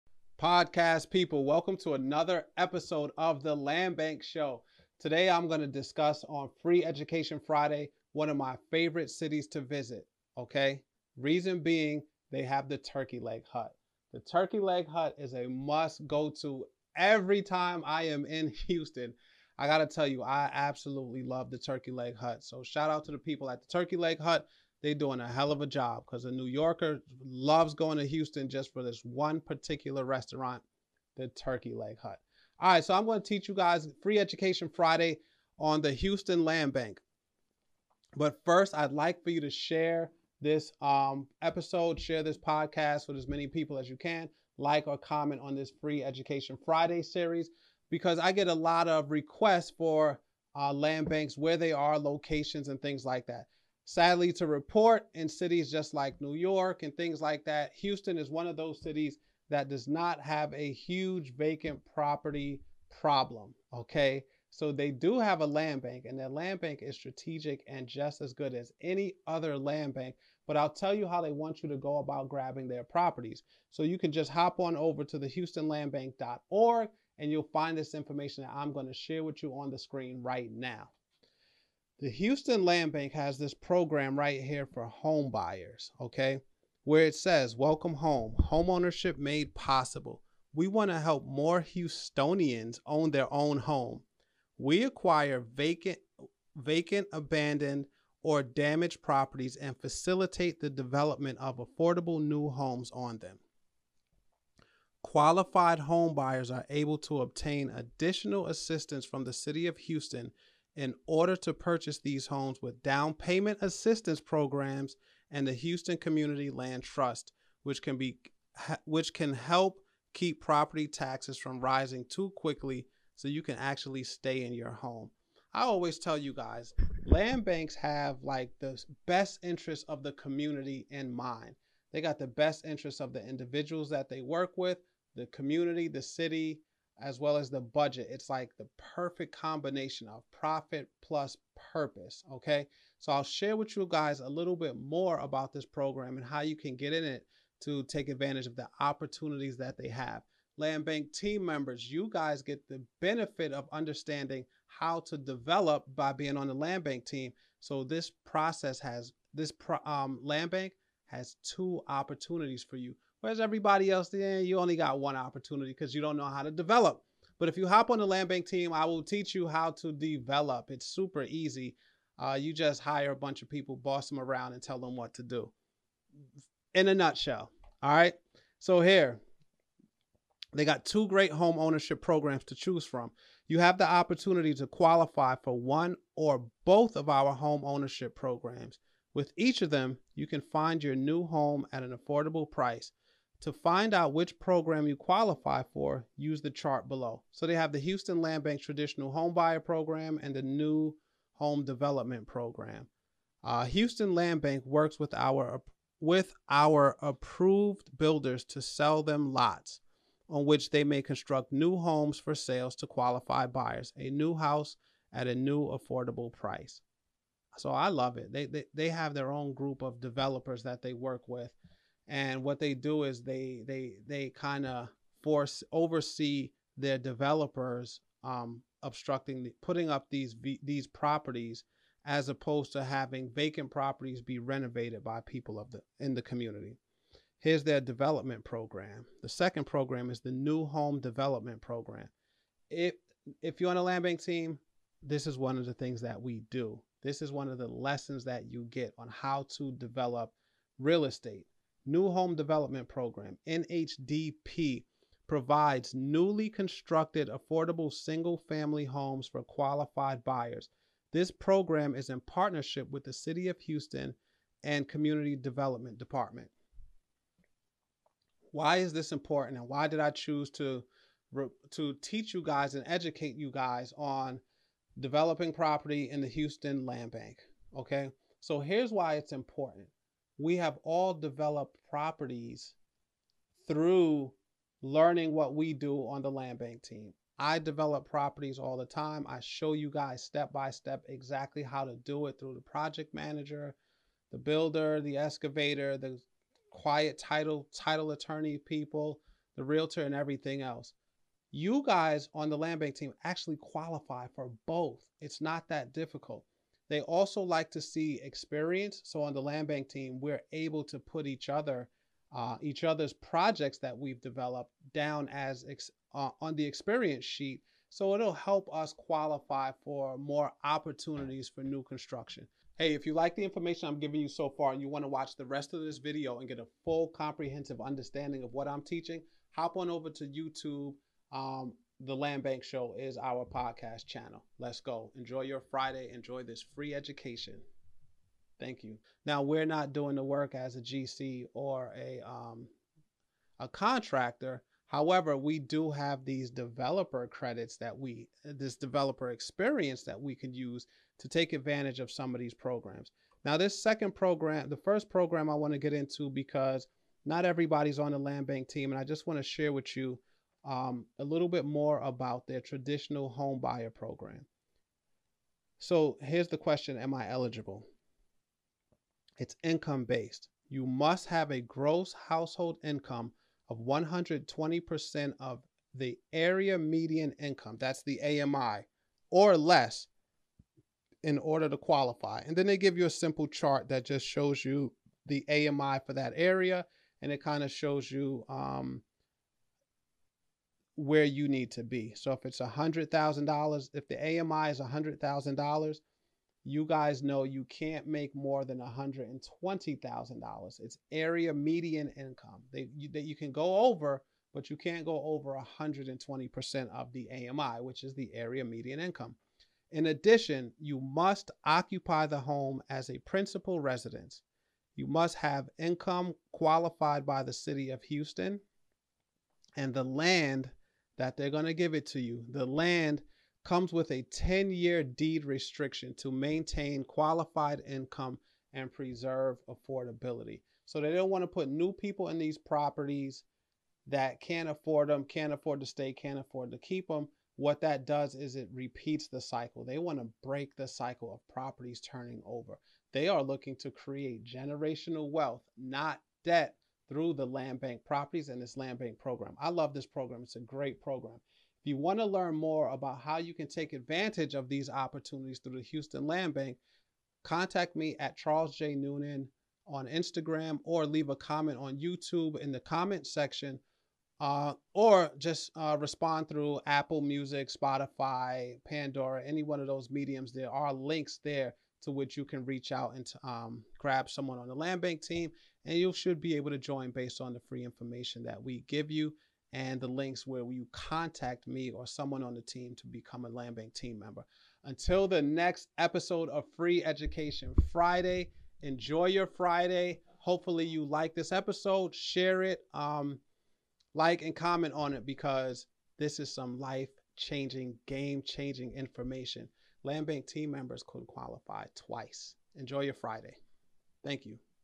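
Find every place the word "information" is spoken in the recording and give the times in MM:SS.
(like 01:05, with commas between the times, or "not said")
01:17, 05:23, 07:57, 08:18.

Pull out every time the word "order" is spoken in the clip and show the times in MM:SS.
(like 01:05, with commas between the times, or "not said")
01:51, 06:21.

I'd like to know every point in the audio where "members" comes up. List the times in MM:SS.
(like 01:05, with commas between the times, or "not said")
02:31, 08:04, 08:20.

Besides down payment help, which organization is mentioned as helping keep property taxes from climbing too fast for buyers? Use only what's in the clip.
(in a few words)
Houston Community Land Trust.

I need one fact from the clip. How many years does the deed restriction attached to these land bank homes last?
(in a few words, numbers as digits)
10 years.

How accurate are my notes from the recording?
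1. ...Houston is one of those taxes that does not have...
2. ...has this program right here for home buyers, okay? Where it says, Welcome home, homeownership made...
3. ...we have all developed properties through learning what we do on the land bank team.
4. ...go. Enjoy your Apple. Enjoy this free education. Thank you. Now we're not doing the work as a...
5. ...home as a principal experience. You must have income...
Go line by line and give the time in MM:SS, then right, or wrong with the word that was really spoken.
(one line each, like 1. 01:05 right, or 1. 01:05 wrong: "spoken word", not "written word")
1. 00:57 wrong: "cities", not "taxes"
2. 01:23 right
3. 04:40 right
4. 05:34 wrong: "Friday", not "Apple"
5. 06:52 wrong: "residence", not "experience".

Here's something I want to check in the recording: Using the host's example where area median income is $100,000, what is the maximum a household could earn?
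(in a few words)
$120,000.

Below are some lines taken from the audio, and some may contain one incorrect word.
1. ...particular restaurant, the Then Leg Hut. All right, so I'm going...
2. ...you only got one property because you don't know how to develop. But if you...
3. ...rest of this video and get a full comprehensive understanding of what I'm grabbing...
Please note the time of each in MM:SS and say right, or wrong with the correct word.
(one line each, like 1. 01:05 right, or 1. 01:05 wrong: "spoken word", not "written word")
1. 00:29 wrong: "Turkey", not "Then"
2. 02:44 wrong: "opportunity", not "property"
3. 05:25 wrong: "teaching", not "grabbing".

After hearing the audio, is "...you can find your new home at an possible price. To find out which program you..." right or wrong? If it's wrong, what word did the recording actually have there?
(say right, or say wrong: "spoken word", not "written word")
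wrong: "affordable", not "possible".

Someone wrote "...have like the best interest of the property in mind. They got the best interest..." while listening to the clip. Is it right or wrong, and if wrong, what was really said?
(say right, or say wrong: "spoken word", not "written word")
wrong: "community", not "property".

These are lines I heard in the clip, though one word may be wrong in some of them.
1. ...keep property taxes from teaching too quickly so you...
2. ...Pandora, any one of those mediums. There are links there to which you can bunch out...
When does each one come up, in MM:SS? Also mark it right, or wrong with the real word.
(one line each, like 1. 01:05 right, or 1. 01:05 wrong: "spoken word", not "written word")
1. 02:00 wrong: "rising", not "teaching"
2. 07:48 wrong: "reach", not "bunch".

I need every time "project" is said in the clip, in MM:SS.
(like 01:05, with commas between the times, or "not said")
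04:52, 05:13.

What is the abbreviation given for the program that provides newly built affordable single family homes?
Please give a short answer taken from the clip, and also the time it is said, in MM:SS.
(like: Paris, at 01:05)
NHDP, at 04:13.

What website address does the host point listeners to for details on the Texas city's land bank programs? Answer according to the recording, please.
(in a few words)
HoustonLandBank.org.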